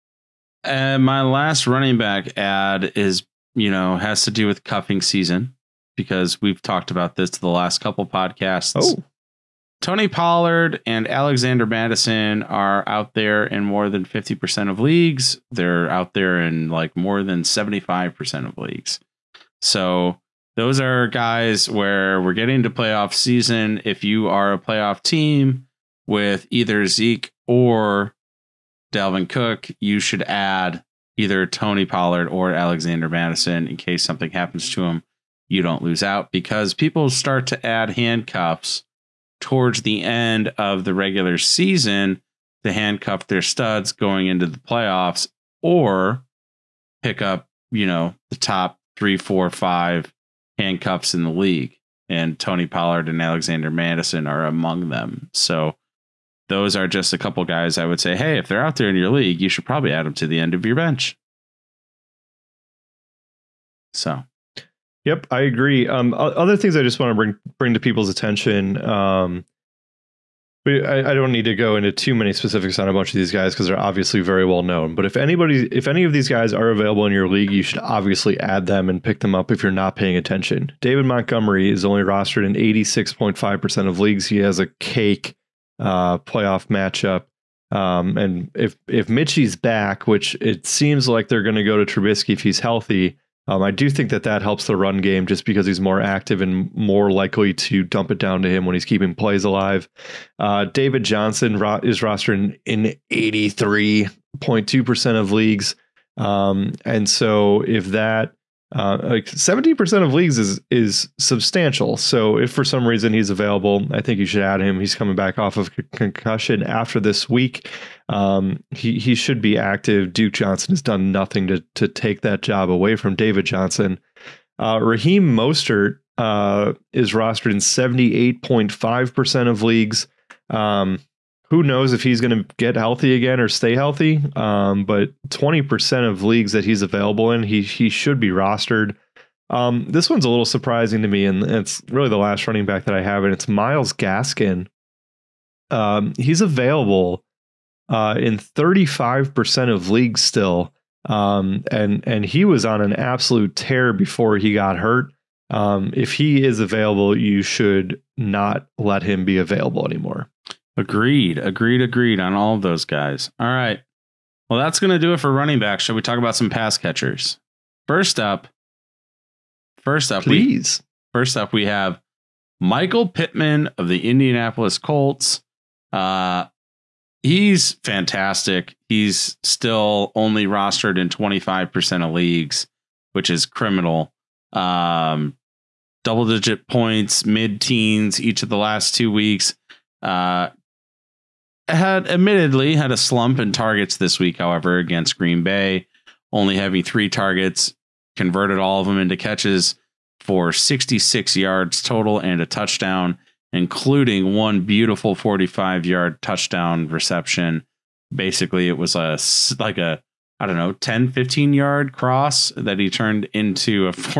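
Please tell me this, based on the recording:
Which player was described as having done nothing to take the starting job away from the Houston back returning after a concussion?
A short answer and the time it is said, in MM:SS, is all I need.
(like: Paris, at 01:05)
Duke Johnson, at 02:00.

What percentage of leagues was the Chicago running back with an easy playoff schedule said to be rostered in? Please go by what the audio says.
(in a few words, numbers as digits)
86.5%.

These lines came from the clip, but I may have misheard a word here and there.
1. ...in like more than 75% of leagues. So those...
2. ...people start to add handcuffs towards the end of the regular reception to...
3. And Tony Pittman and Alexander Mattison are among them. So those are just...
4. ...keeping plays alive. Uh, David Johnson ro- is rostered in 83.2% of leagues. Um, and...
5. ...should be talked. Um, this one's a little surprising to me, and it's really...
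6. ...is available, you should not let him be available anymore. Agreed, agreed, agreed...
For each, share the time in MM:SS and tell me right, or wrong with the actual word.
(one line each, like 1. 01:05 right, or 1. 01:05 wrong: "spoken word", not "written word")
1. 00:16 right
2. 00:36 wrong: "season", not "reception"
3. 00:52 wrong: "Pollard", not "Pittman"
4. 01:38 right
5. 02:17 wrong: "rostered", not "talked"
6. 02:36 right.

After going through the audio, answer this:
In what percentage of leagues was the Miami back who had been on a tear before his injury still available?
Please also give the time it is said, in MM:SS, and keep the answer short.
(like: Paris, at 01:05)
35%, at 02:28.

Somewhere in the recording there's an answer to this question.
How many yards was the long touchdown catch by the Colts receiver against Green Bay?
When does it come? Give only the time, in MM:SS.
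03:25.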